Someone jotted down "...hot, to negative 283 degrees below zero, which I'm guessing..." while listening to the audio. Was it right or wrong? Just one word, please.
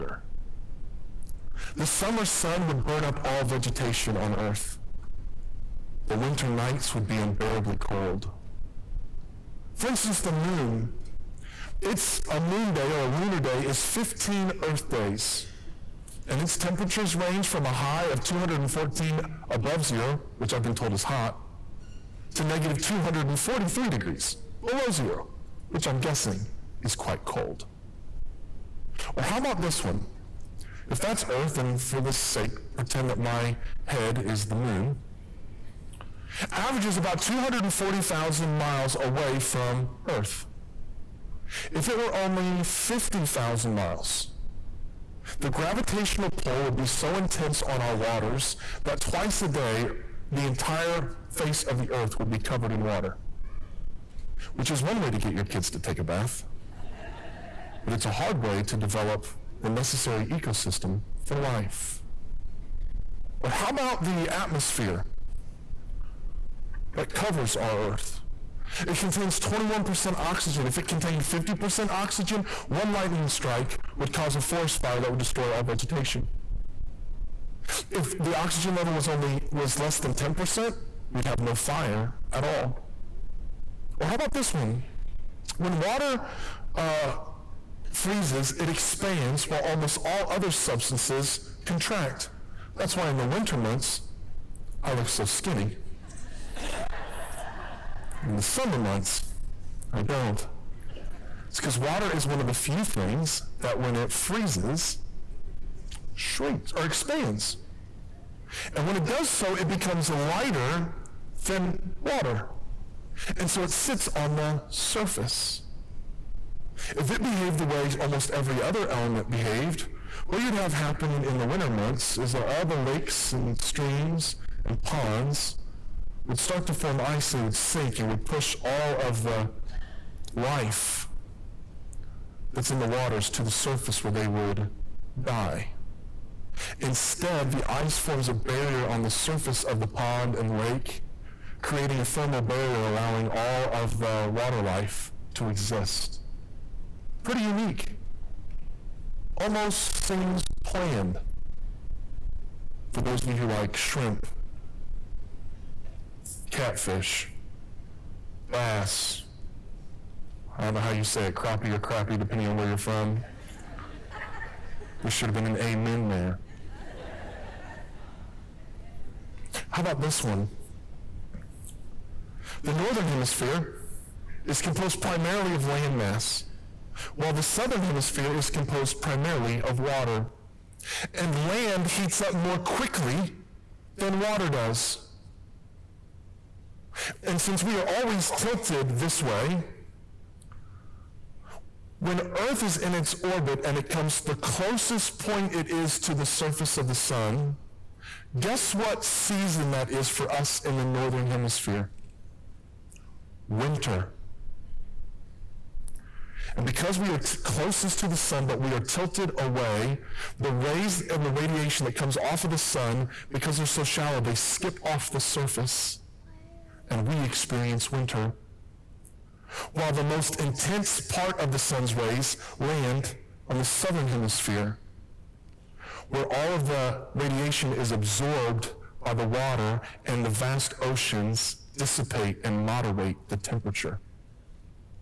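wrong.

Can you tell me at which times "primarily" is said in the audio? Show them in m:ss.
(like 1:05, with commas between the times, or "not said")
2:55, 2:59.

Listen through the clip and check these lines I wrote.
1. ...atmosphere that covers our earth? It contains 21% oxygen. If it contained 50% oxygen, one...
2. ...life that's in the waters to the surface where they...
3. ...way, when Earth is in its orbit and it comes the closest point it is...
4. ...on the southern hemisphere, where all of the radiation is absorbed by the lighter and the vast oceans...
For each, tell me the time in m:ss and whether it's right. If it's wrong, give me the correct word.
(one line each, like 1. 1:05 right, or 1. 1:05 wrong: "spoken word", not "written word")
1. 1:04 right
2. 2:10 right
3. 3:09 right
4. 3:43 wrong: "water", not "lighter".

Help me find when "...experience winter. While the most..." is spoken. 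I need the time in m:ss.
3:37.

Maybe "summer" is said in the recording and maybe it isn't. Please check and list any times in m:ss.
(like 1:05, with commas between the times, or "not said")
0:01, 1:38.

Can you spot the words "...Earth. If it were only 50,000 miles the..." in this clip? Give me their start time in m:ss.
0:40.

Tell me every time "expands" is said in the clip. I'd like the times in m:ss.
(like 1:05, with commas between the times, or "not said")
1:28, 1:46.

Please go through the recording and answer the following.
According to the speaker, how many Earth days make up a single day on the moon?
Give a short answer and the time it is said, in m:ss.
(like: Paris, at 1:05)
15, at 0:13.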